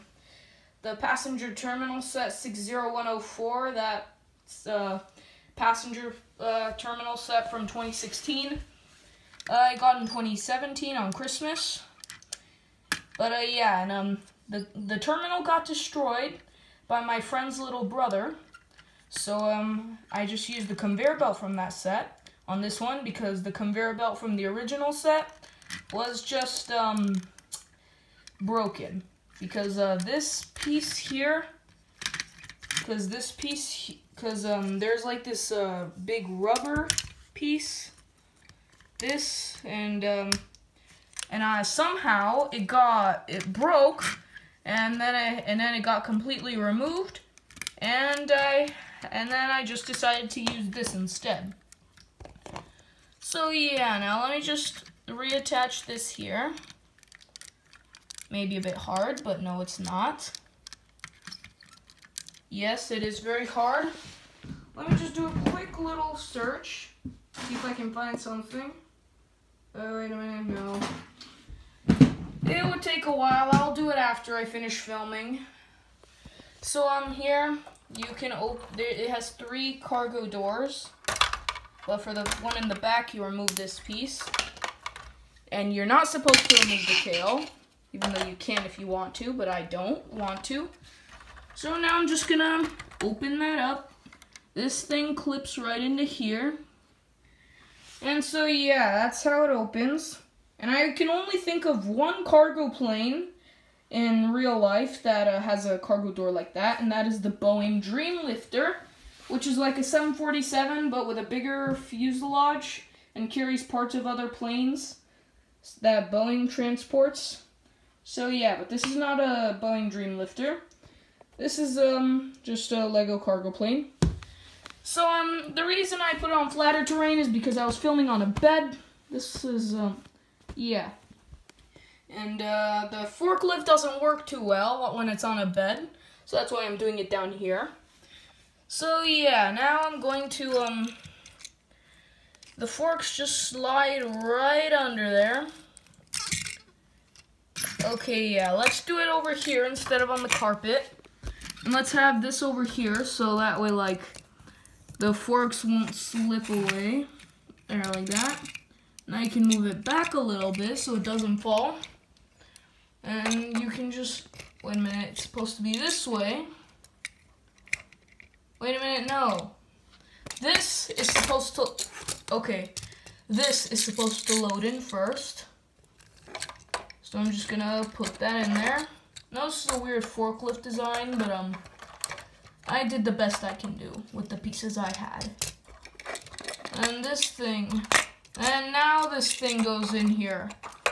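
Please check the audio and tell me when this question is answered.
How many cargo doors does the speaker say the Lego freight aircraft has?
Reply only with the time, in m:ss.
1:19.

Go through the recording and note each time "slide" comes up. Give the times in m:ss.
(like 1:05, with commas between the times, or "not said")
2:23.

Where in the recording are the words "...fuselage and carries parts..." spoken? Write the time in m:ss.
1:51.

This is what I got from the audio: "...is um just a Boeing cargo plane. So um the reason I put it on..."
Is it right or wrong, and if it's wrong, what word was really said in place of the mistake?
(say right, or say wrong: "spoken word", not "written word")
wrong: "Lego", not "Boeing".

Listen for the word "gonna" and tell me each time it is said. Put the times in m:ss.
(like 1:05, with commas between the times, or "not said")
1:32, 2:57.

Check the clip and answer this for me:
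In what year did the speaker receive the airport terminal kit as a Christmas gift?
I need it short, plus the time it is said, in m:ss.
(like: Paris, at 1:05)
2017, at 0:10.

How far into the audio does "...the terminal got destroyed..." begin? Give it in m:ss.
0:14.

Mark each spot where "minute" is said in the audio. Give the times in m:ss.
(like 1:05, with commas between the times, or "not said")
1:10, 2:44, 2:48.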